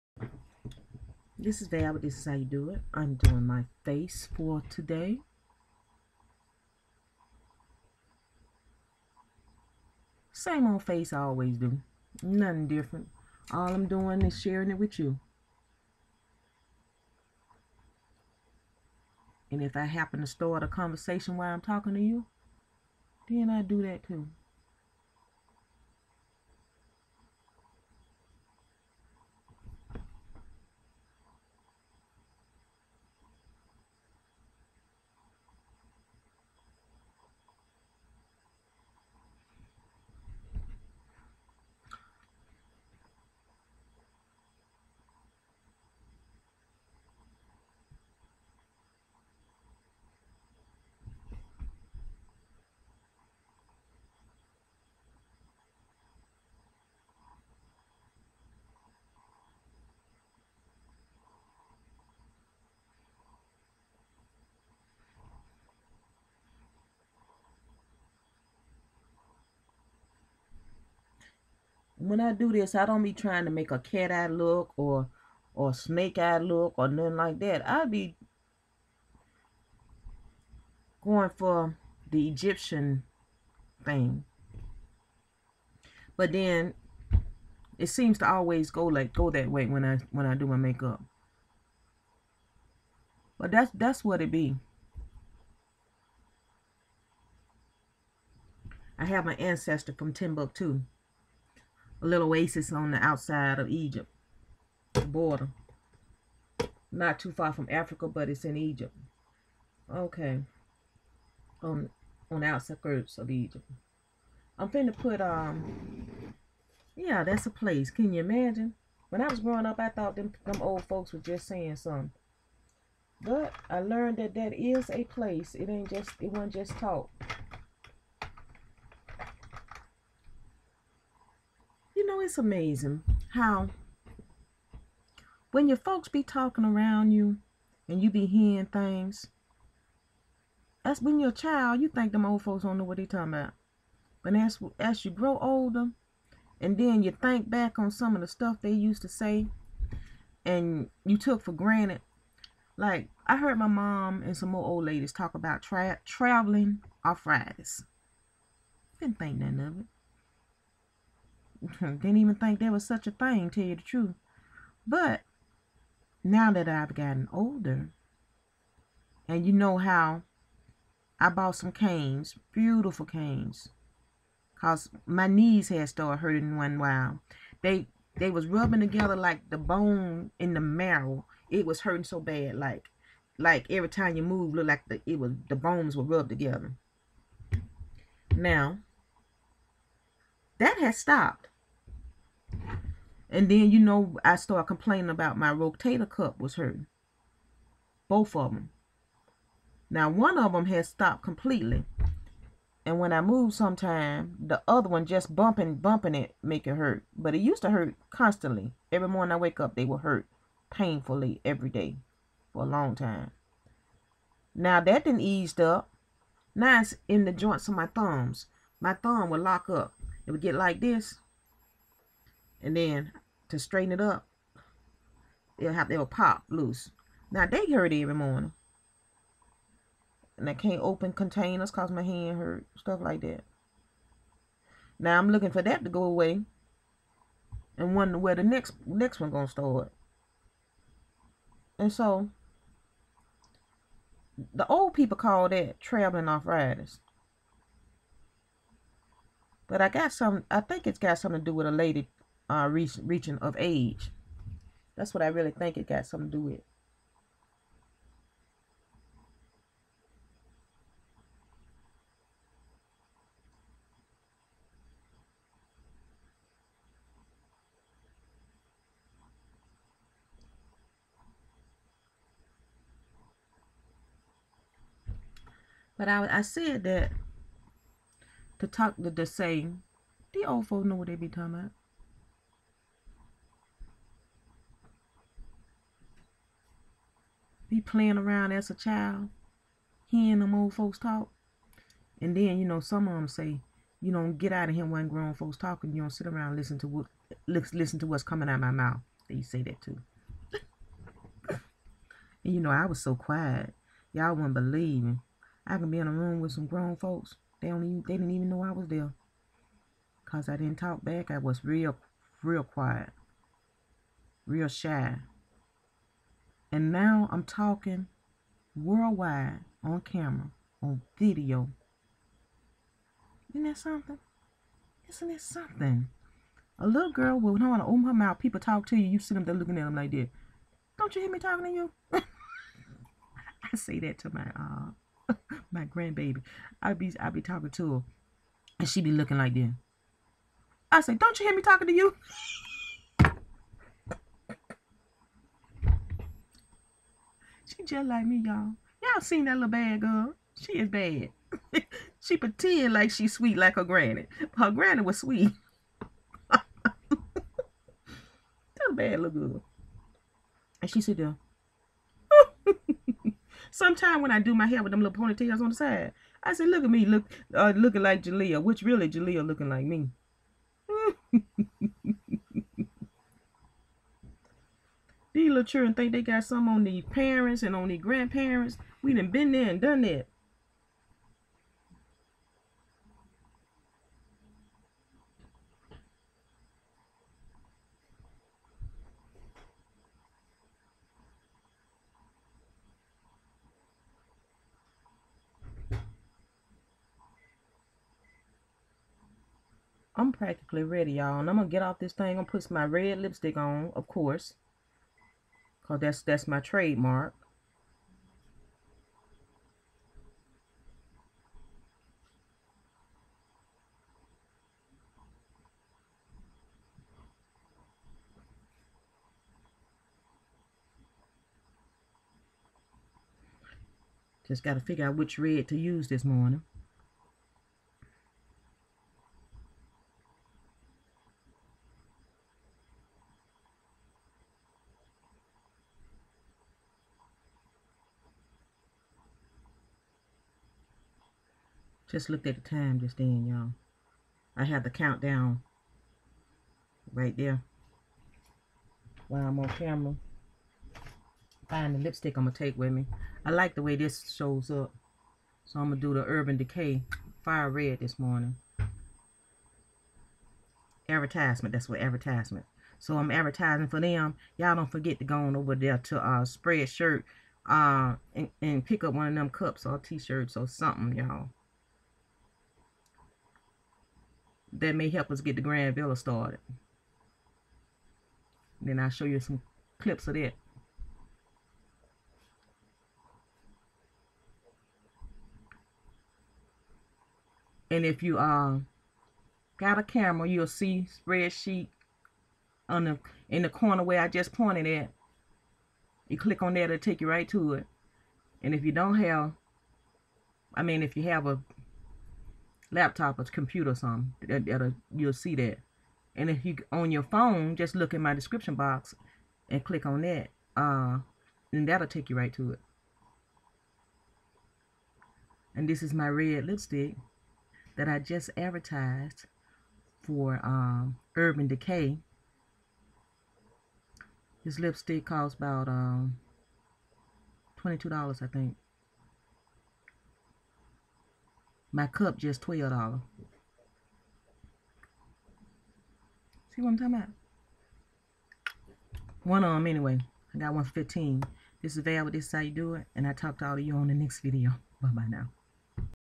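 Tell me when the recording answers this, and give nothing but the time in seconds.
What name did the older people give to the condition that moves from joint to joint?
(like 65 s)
245 s.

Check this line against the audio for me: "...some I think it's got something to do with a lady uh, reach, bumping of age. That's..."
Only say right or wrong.
wrong.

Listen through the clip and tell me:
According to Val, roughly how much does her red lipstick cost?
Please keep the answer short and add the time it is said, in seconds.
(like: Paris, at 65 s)
$22, at 527 s.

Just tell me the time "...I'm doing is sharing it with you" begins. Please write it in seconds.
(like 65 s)
13 s.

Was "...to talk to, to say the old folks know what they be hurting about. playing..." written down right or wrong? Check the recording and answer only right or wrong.
wrong.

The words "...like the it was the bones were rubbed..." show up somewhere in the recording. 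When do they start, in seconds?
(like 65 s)
184 s.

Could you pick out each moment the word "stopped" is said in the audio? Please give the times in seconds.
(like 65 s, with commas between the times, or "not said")
190 s, 200 s.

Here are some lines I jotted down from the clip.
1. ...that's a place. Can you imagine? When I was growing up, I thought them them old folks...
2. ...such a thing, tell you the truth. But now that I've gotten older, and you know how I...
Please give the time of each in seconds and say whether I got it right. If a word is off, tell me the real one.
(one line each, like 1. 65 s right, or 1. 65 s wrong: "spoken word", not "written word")
1. 117 s right
2. 162 s right.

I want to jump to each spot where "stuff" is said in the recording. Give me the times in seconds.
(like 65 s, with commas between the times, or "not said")
148 s, 232 s.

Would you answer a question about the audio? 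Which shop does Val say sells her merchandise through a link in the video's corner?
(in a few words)
Spreadshirt.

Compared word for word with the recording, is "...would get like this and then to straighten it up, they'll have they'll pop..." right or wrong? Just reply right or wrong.
right.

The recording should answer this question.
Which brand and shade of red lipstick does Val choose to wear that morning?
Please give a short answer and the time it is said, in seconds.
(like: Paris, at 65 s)
Urban Decay Fire Red, at 456 s.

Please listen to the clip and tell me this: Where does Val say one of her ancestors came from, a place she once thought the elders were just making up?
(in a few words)
Timbuktu.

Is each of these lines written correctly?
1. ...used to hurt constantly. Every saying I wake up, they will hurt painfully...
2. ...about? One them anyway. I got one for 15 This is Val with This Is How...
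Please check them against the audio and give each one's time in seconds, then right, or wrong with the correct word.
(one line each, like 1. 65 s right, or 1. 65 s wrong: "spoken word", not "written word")
1. 207 s wrong: "morning", not "saying"
2. 537 s right.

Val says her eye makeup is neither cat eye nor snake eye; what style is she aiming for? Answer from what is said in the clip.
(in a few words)
Egyptian.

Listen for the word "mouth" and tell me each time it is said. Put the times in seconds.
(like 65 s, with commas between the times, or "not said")
298 s, 328 s.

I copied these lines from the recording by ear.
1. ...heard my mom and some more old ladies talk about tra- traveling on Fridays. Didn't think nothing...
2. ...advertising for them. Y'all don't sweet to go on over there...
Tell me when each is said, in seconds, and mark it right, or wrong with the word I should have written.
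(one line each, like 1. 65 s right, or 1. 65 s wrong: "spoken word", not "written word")
1. 153 s right
2. 463 s wrong: "forget", not "sweet".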